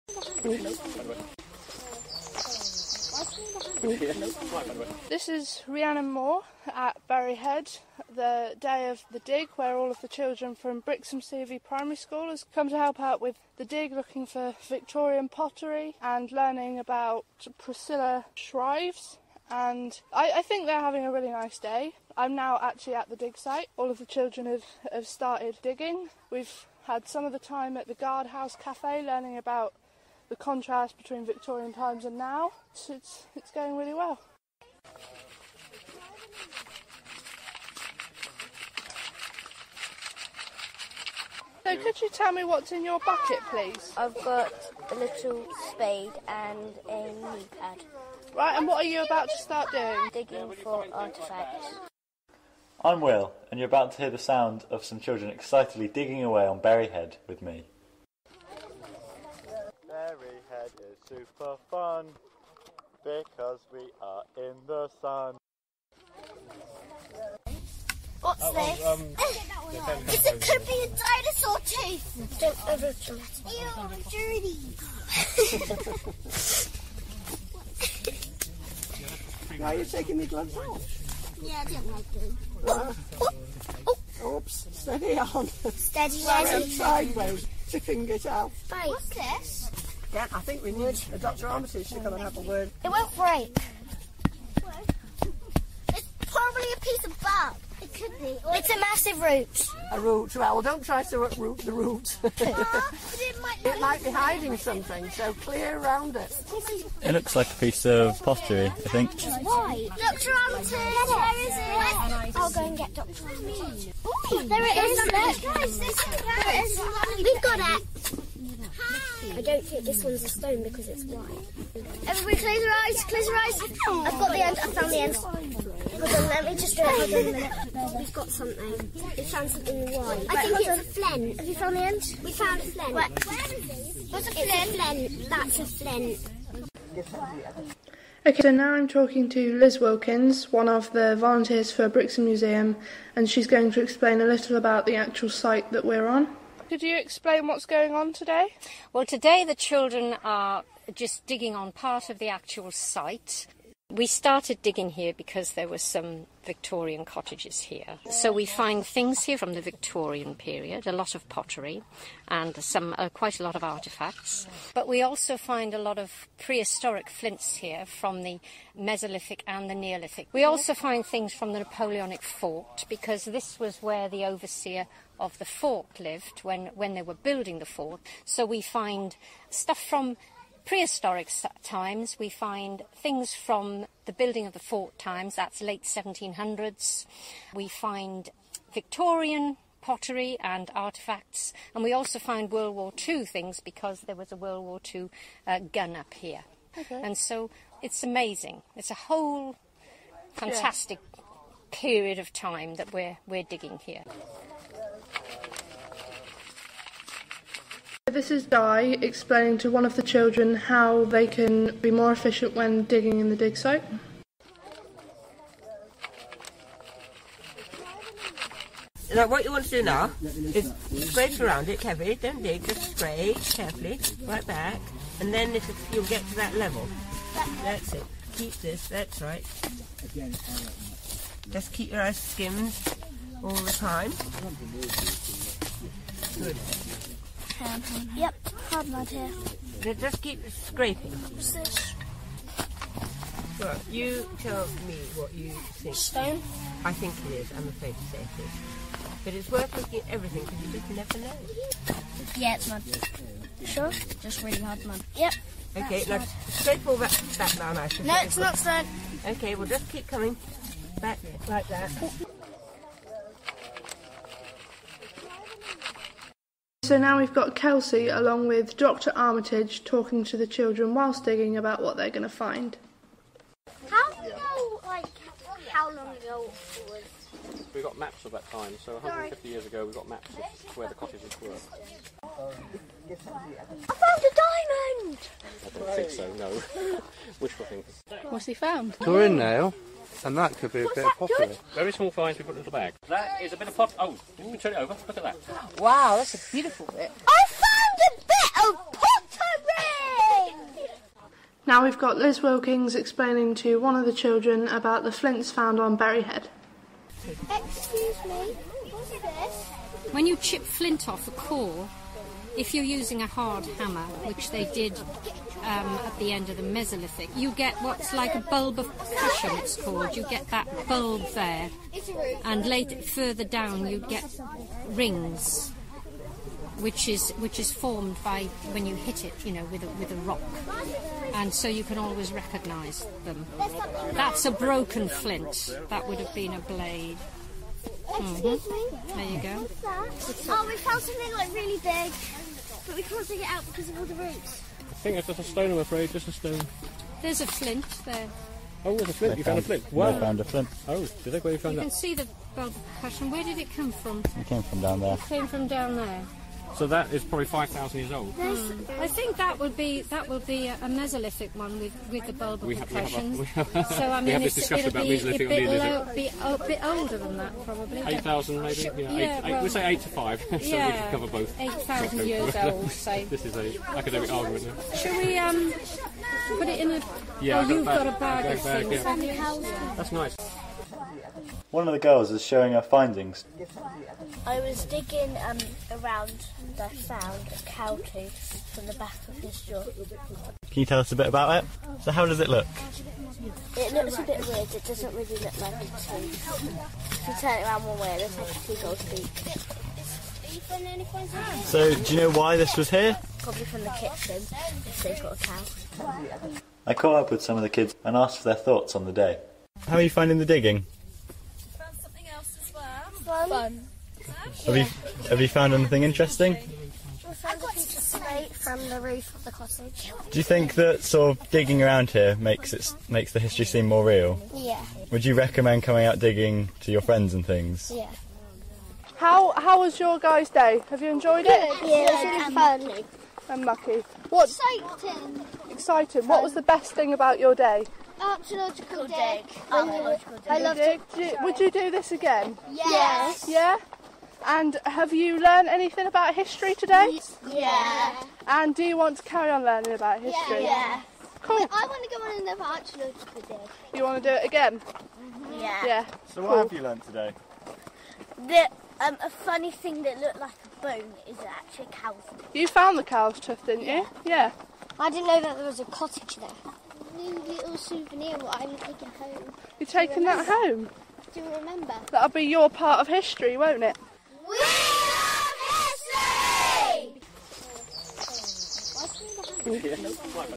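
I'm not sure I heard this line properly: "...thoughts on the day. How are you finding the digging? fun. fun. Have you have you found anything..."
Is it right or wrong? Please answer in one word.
right.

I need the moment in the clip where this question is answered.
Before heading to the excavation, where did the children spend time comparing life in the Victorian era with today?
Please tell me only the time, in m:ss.
0:27.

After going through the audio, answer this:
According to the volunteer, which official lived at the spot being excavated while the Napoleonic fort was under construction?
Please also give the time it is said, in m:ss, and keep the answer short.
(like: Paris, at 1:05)
The overseer of the fort, at 2:54.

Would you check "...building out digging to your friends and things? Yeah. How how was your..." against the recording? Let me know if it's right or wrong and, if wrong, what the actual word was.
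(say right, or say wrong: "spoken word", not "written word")
wrong: "coming", not "building".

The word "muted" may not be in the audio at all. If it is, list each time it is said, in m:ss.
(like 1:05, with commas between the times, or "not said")
not said.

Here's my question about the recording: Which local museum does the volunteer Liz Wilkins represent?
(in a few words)
Brixham Museum.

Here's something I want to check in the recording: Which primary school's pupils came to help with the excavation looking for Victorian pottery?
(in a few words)
Brixham CV Primary School.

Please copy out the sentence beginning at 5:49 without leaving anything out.
They you found, found, a flint.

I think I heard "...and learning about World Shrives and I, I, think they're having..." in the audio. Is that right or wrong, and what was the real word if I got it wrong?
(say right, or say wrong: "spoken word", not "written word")
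wrong: "Priscilla", not "World".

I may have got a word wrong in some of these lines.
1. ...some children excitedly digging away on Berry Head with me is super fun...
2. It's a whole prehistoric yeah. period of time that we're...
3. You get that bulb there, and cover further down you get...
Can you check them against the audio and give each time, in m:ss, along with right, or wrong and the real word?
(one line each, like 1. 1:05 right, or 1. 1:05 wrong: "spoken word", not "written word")
1. 0:54 right
2. 3:18 wrong: "fantastic", not "prehistoric"
3. 5:20 wrong: "later", not "cover".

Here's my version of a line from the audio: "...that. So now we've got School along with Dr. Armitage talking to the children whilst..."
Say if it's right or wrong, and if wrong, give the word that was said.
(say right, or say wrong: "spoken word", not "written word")
wrong: "Kelsey", not "School".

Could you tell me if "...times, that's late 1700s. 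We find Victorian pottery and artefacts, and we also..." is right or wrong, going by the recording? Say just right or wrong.
right.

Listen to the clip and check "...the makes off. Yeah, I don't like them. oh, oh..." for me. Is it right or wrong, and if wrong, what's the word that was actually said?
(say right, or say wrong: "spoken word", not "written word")
wrong: "gloves", not "makes".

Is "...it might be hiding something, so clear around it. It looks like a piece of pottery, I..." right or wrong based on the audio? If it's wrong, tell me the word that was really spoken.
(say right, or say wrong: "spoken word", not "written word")
right.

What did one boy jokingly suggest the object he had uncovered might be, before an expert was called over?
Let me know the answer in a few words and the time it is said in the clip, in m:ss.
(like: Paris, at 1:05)
A dinosaur tooth, at 1:11.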